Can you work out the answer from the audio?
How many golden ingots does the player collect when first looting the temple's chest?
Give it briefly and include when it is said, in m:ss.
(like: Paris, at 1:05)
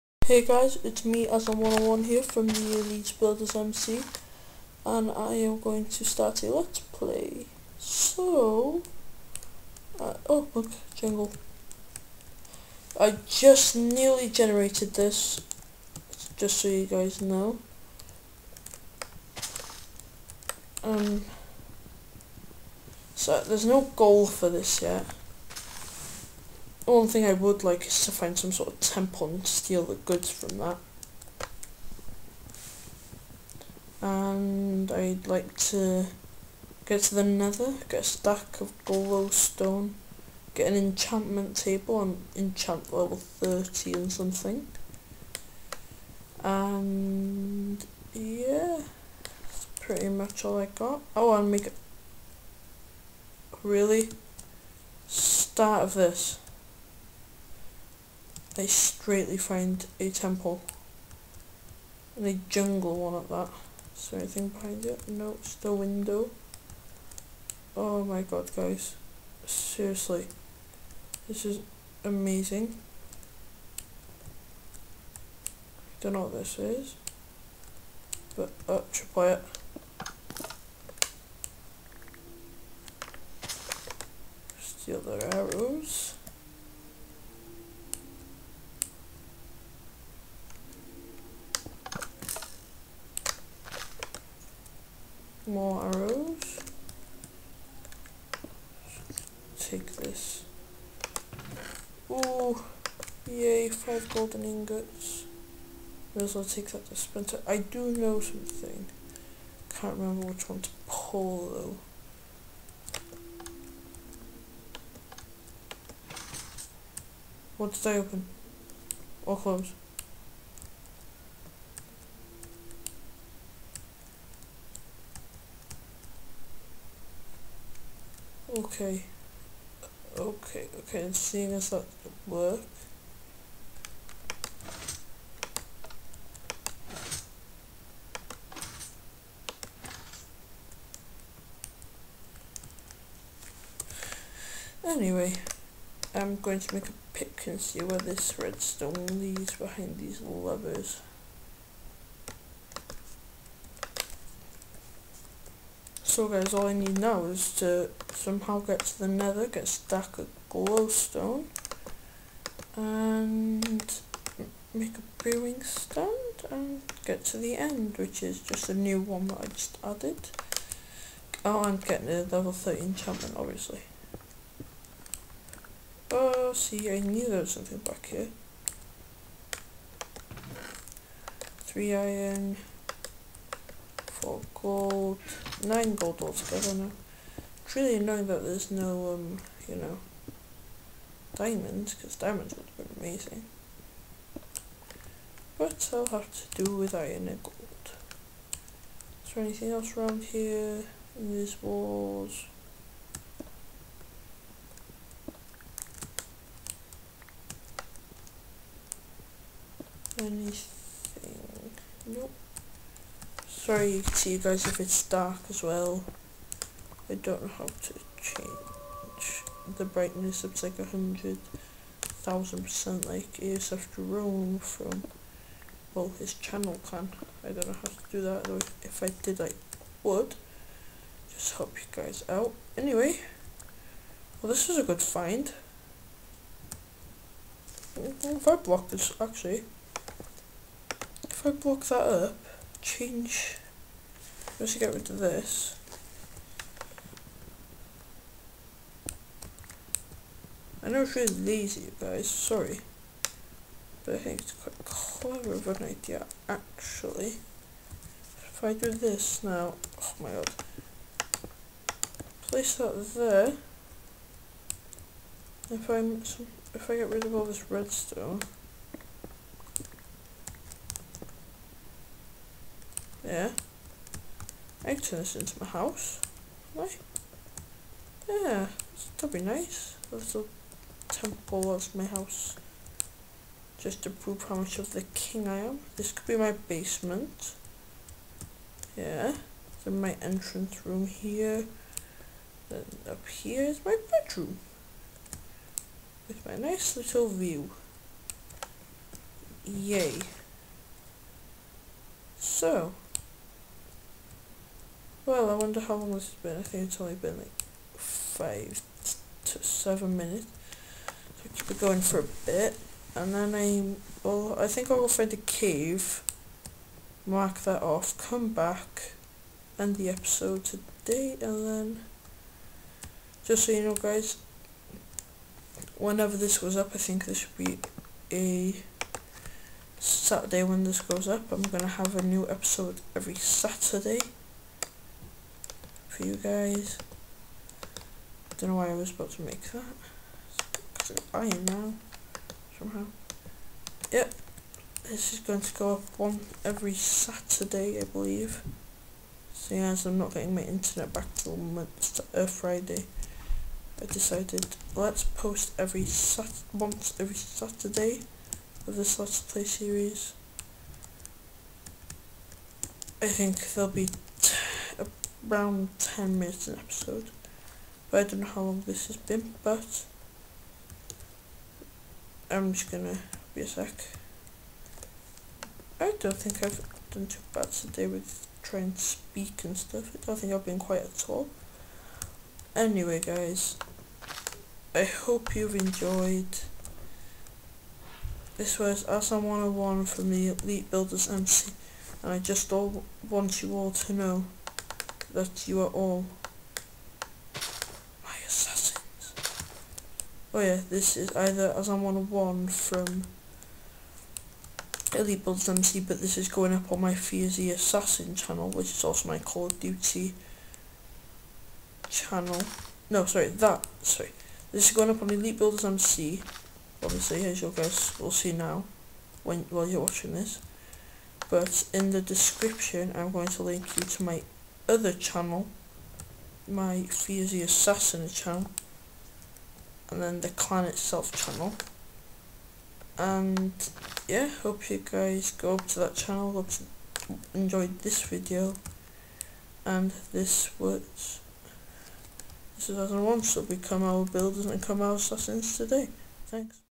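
5, at 1:43.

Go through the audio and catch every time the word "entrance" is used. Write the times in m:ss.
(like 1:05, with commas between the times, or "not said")
4:50.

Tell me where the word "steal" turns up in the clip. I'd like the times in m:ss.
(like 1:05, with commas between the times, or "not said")
0:29, 1:24.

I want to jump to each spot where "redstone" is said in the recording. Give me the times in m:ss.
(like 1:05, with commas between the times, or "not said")
2:28, 4:27.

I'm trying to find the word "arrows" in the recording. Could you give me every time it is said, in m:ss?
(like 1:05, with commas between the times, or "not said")
1:25, 1:35.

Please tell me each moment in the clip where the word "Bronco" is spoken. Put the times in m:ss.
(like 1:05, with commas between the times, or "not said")
not said.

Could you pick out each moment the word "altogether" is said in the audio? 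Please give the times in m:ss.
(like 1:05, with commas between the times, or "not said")
3:06.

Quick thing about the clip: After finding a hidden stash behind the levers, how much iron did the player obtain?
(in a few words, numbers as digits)
3.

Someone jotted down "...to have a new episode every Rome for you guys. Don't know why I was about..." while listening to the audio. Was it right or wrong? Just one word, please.
wrong.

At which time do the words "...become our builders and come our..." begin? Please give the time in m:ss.
7:23.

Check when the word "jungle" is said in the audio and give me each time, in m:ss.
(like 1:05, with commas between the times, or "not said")
0:10, 1:02.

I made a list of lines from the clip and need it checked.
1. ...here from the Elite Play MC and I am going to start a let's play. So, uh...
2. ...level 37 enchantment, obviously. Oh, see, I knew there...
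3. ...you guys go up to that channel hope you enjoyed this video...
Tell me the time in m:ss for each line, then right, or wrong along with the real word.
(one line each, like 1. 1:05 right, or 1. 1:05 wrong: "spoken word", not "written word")
1. 0:02 wrong: "Builders", not "Play"
2. 2:52 wrong: "30", not "37"
3. 7:14 right.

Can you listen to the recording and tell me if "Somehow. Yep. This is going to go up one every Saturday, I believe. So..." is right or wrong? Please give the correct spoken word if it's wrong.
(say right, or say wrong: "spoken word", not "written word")
right.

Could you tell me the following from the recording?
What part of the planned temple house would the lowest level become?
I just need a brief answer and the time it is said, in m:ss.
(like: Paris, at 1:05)
Basement, at 4:46.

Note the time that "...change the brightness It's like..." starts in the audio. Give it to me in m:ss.
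3:38.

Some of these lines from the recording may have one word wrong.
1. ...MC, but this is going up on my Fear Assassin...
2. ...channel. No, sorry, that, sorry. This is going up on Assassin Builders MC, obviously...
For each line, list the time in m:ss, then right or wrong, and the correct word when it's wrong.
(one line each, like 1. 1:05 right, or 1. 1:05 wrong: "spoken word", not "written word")
1. 6:45 right
2. 6:52 wrong: "Elite", not "Assassin".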